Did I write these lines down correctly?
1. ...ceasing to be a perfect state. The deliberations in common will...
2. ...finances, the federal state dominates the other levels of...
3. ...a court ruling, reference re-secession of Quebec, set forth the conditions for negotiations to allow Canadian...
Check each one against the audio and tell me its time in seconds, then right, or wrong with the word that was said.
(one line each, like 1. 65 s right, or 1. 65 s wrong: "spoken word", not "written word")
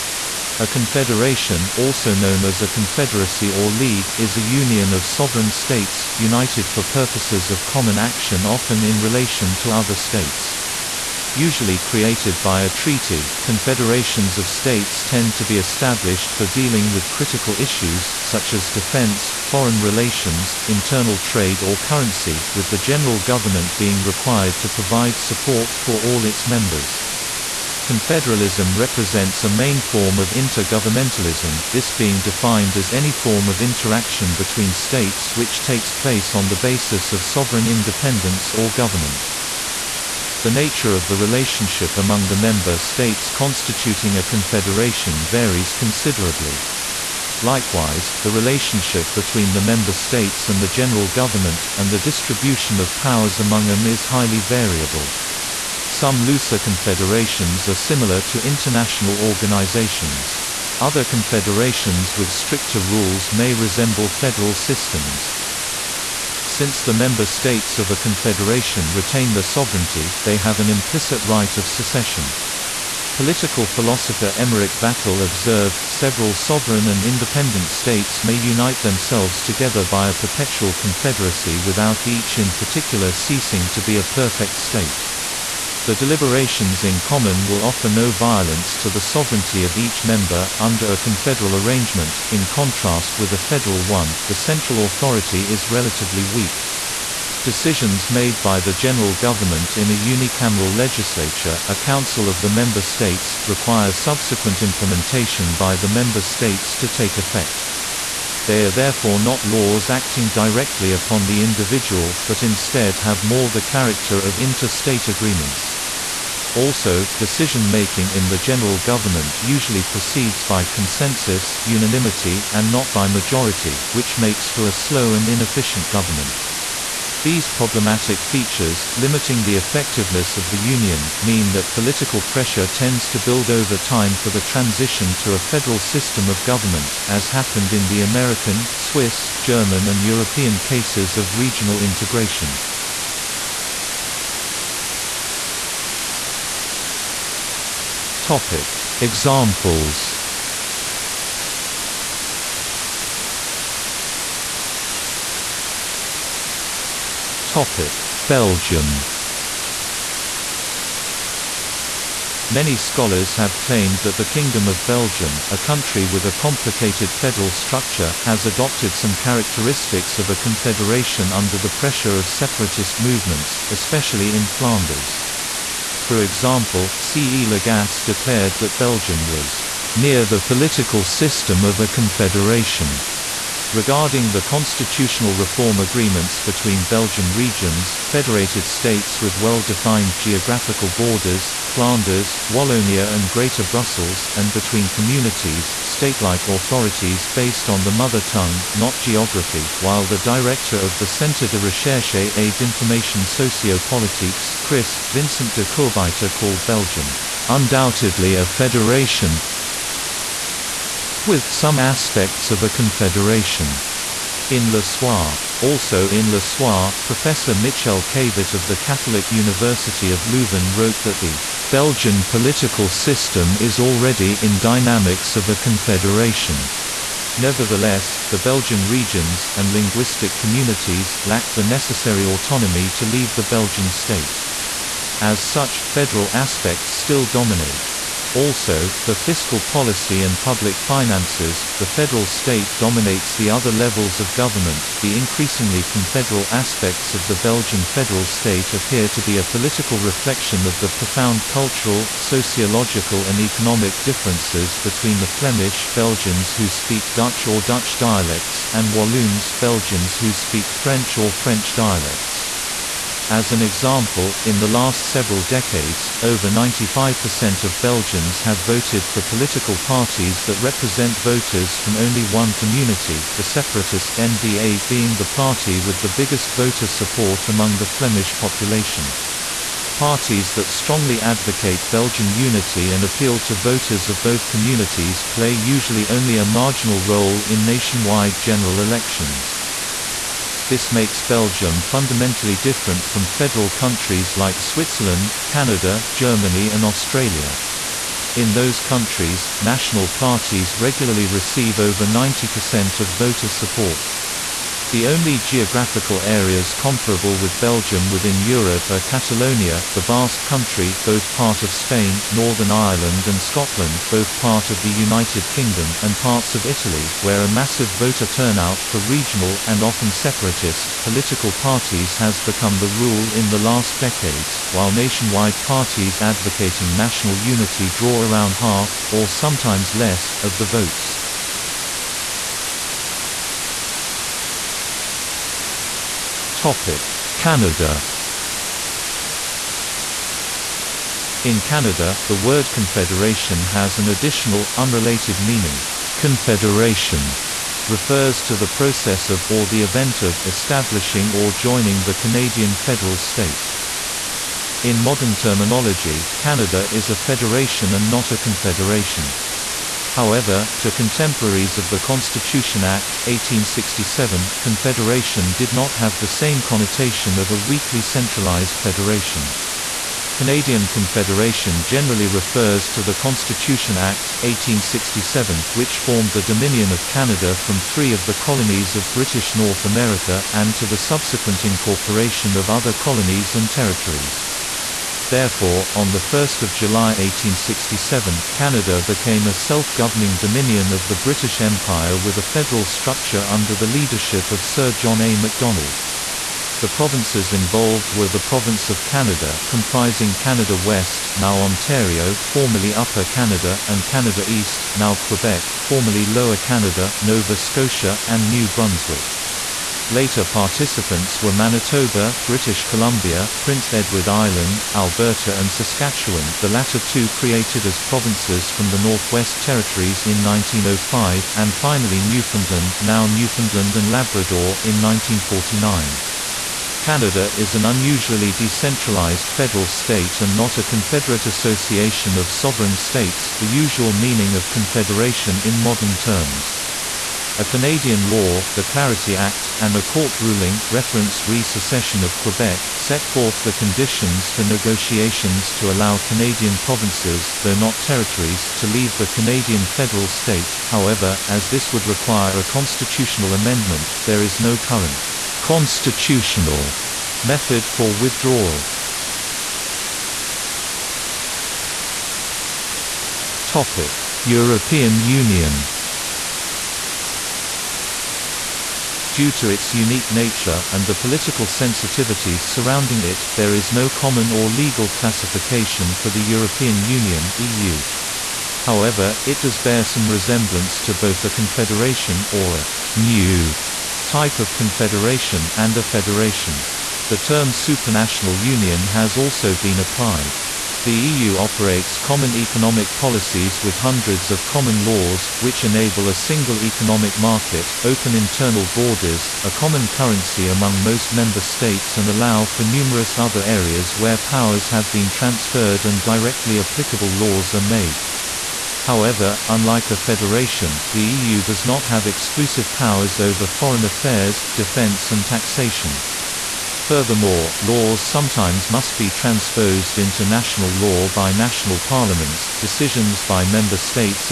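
1. 83 s right
2. 240 s right
3. 439 s right.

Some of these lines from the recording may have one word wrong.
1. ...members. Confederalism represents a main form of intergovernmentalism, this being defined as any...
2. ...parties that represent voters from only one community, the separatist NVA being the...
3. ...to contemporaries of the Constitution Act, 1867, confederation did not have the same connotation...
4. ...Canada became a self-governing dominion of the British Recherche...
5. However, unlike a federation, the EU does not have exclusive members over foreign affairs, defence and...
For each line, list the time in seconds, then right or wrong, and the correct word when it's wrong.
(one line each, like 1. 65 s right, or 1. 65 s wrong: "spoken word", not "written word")
1. 26 s right
2. 269 s right
3. 360 s right
4. 388 s wrong: "Empire", not "Recherche"
5. 509 s wrong: "powers", not "members".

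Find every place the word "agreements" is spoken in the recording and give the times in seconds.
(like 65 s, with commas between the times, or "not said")
115 s, 185 s.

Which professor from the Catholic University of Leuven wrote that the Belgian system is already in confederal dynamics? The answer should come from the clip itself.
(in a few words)
Michel Quévit.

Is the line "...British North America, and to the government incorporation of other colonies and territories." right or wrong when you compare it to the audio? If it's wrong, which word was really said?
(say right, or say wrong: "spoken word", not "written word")
wrong: "subsequent", not "government".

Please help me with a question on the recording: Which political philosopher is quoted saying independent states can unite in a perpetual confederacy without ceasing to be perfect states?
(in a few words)
Emmerich Vattel.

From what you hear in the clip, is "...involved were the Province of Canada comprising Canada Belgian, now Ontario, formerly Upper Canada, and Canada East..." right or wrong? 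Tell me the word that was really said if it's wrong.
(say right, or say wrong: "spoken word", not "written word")
wrong: "West", not "Belgian".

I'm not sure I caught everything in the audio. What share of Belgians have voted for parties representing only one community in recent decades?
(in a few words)
over 95%.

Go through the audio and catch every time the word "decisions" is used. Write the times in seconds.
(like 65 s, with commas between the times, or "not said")
97 s, 117 s, 522 s.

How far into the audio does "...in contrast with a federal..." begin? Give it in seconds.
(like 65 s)
92 s.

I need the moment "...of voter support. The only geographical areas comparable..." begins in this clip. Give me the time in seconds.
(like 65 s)
303 s.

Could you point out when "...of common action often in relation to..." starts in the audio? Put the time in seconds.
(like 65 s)
7 s.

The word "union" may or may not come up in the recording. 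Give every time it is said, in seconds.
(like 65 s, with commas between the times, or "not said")
4 s, 130 s, 465 s, 477 s, 488 s.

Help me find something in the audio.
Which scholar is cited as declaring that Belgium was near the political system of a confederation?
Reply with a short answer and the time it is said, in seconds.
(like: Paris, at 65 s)
C. E. Lagasse, at 177 s.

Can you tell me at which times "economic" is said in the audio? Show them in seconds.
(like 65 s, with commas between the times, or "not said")
253 s, 492 s, 496 s.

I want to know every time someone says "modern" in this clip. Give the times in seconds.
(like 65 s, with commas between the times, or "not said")
354 s, 435 s.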